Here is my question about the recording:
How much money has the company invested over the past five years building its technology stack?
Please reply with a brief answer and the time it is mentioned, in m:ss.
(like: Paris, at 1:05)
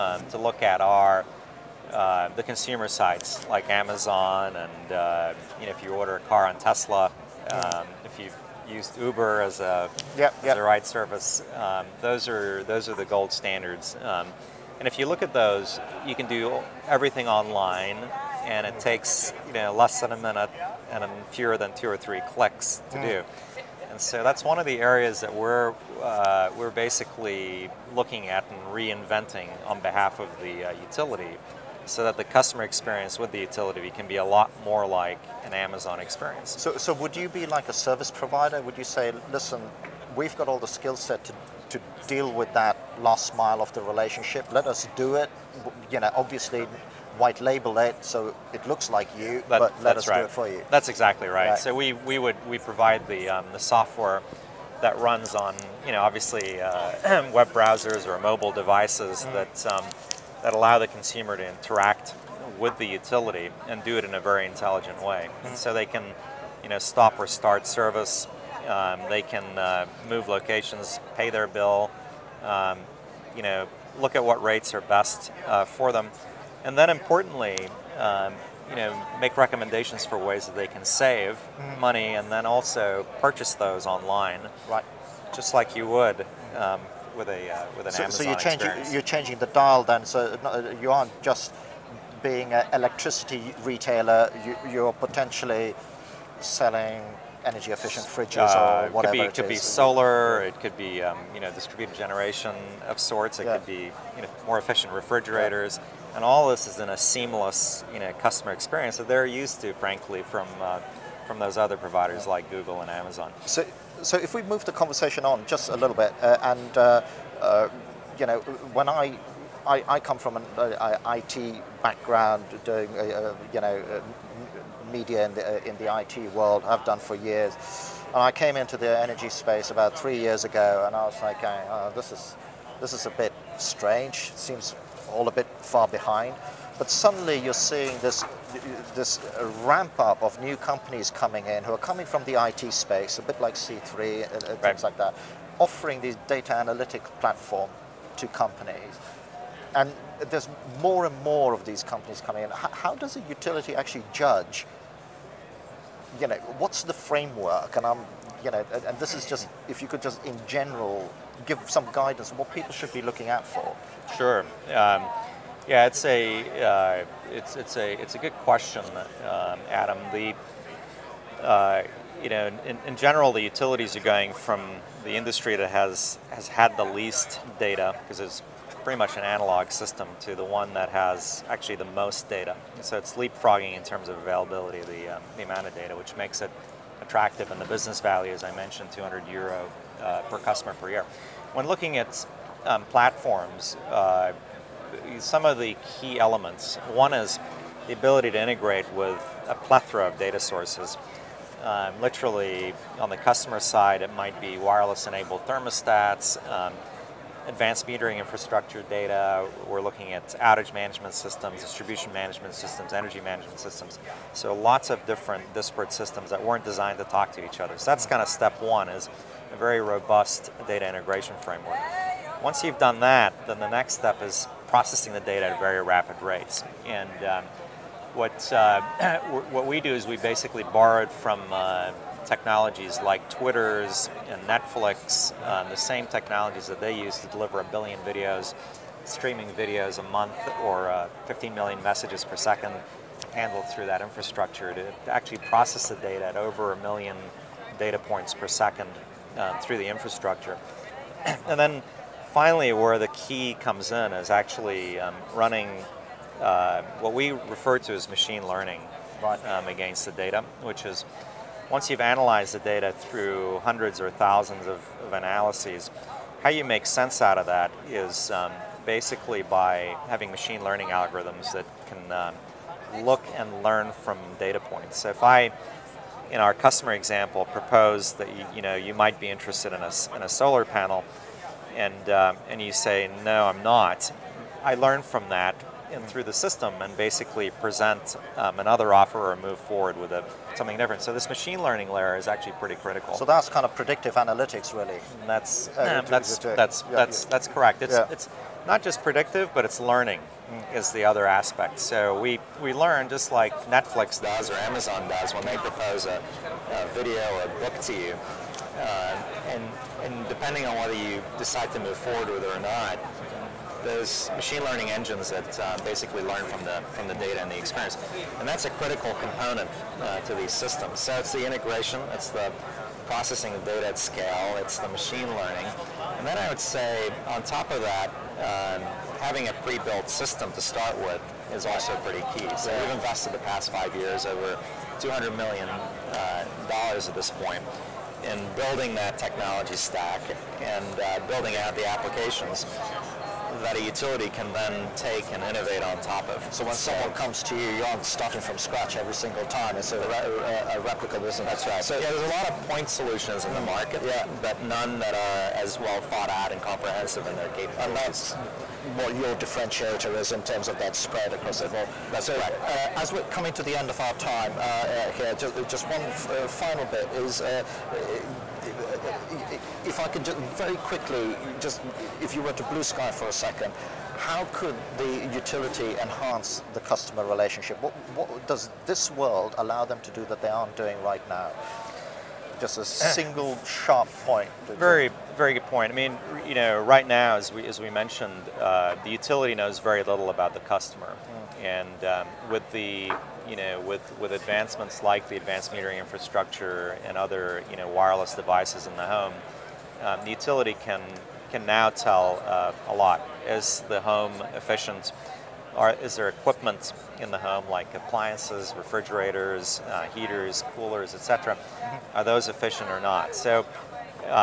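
200 million dollars, at 5:34.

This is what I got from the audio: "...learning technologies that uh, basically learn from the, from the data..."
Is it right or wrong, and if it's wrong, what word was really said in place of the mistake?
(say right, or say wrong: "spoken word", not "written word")
wrong: "engines", not "technologies".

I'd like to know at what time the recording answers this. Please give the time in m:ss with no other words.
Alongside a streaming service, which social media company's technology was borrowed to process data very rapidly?
3:53.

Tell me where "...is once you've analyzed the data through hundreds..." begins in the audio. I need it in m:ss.
4:20.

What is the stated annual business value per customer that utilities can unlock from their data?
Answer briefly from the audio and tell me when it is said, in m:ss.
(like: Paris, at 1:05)
200 euro, at 3:08.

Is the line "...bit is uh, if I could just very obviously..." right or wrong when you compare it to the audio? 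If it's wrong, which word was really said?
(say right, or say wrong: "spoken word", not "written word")
wrong: "quickly", not "obviously".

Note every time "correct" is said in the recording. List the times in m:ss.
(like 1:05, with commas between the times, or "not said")
4:57, 6:02.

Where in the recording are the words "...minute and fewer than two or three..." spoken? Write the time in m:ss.
0:20.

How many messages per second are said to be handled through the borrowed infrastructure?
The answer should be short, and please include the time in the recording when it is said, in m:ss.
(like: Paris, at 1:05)
15 million, at 4:01.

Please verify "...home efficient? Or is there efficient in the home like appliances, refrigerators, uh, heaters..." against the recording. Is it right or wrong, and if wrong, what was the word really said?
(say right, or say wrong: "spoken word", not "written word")
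wrong: "equipment", not "efficient".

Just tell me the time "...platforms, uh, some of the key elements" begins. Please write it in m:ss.
3:12.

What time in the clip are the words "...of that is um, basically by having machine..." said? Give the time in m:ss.
4:27.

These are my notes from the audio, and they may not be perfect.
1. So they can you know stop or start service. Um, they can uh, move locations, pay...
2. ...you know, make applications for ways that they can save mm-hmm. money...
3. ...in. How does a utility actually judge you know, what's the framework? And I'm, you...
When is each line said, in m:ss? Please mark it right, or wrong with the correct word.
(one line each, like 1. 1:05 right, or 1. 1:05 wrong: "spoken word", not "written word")
1. 1:05 right
2. 1:18 wrong: "recommendations", not "applications"
3. 2:32 right.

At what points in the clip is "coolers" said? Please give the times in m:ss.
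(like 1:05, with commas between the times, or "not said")
6:50.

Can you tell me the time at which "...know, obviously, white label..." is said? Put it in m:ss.
0:45.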